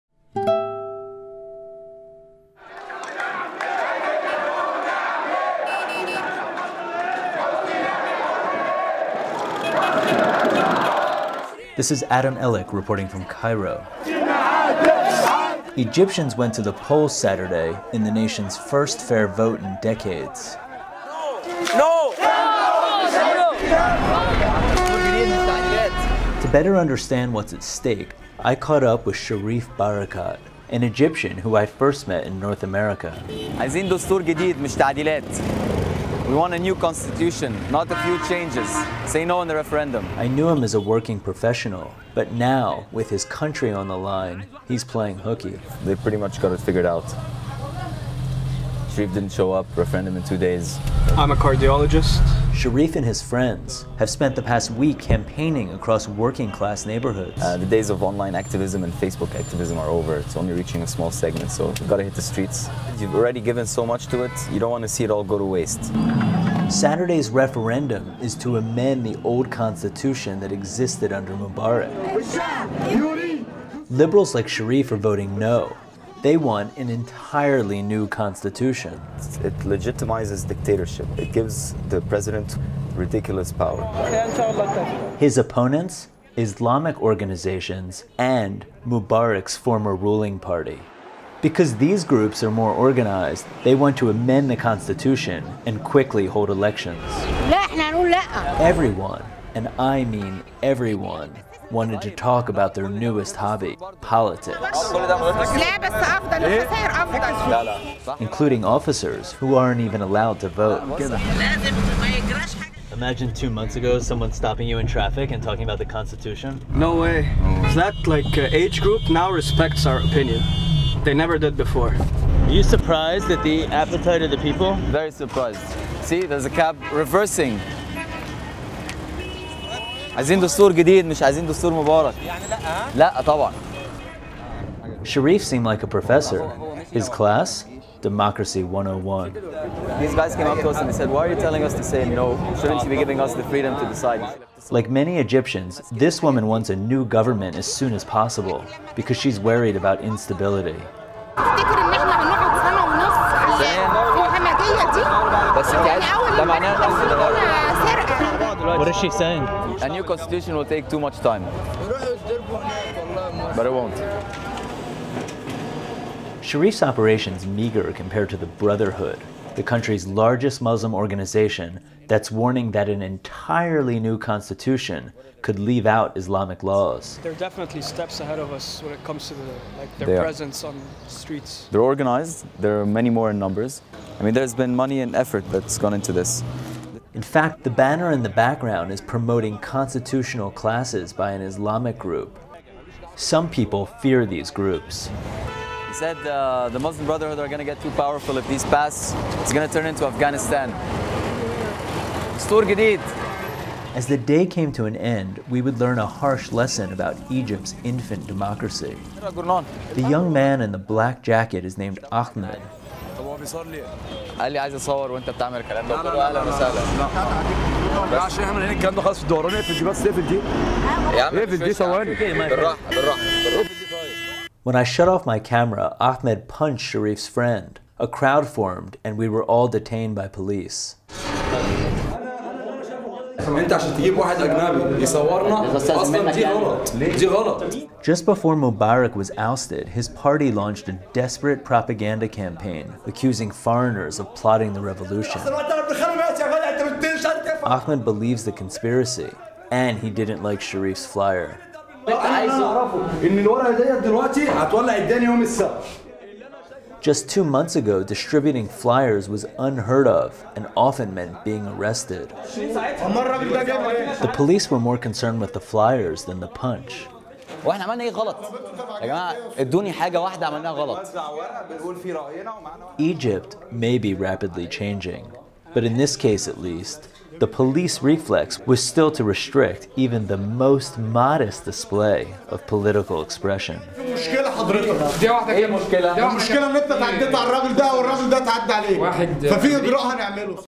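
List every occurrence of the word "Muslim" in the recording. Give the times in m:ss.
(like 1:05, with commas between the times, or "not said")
2:50, 3:16.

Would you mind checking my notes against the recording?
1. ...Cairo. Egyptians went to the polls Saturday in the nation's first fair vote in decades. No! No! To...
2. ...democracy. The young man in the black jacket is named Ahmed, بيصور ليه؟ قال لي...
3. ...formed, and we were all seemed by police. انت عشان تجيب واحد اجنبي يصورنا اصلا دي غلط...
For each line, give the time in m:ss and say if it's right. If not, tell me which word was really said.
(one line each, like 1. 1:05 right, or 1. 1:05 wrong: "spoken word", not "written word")
1. 0:13 right
2. 3:28 right
3. 3:48 wrong: "detained", not "seemed".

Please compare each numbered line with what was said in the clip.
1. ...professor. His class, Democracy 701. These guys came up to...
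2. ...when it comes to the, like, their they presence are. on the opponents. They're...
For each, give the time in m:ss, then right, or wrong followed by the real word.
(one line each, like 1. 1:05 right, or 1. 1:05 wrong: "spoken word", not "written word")
1. 2:15 wrong: "101", not "701"
2. 2:58 wrong: "streets", not "opponents".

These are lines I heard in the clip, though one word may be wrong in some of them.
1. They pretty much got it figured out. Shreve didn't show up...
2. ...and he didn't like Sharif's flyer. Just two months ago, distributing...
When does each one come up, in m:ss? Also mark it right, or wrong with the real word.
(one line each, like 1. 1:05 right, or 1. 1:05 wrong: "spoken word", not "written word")
1. 0:45 right
2. 4:09 right.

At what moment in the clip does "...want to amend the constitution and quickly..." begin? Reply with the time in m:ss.
1:33.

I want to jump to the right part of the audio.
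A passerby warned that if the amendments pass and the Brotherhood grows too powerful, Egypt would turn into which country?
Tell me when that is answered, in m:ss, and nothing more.
3:20.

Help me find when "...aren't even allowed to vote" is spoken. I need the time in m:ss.
1:49.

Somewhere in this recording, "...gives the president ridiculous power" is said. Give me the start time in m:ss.
1:21.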